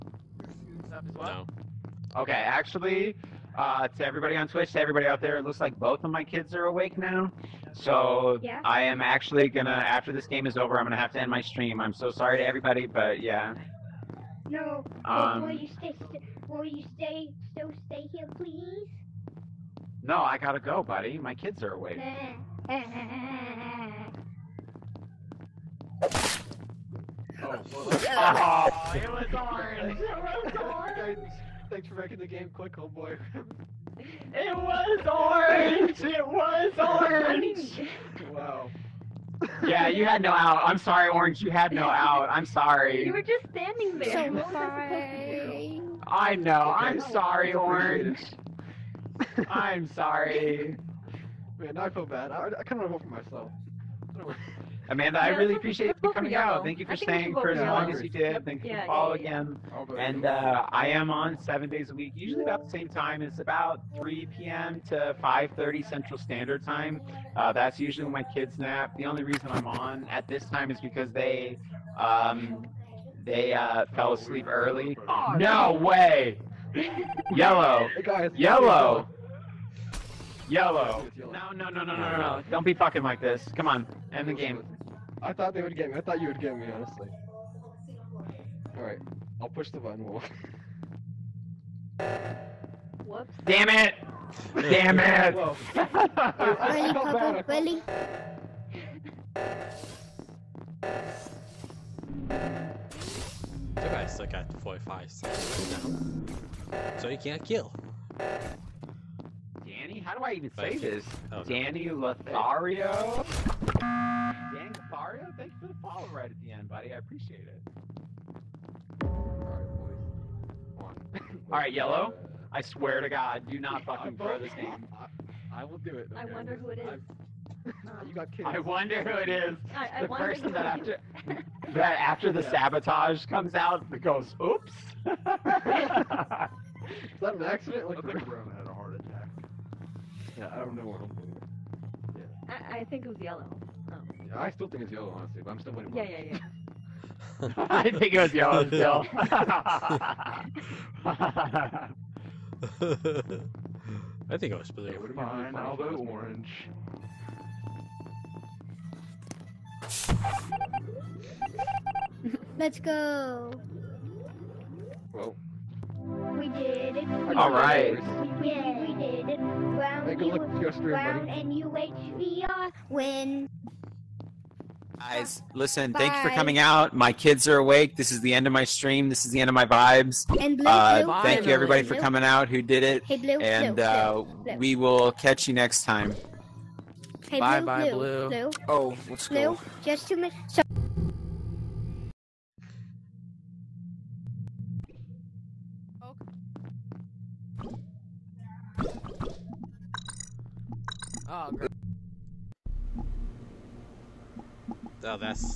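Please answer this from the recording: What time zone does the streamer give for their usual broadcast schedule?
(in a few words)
Central Standard Time.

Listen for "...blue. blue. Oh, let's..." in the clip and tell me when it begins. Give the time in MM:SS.
03:07.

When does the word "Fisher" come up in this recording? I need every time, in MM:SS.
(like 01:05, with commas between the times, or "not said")
not said.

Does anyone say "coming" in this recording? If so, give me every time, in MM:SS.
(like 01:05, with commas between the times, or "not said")
00:56, 02:56, 03:01.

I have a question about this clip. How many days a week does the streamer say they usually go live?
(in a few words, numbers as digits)
7.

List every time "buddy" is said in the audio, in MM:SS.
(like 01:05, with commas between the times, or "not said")
00:20, 01:56, 02:51.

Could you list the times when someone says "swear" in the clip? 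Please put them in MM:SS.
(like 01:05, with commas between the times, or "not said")
02:02.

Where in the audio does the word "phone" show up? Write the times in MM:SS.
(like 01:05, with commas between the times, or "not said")
not said.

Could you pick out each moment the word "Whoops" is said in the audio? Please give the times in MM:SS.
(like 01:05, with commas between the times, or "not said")
01:33.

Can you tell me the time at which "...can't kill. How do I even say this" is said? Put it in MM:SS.
01:47.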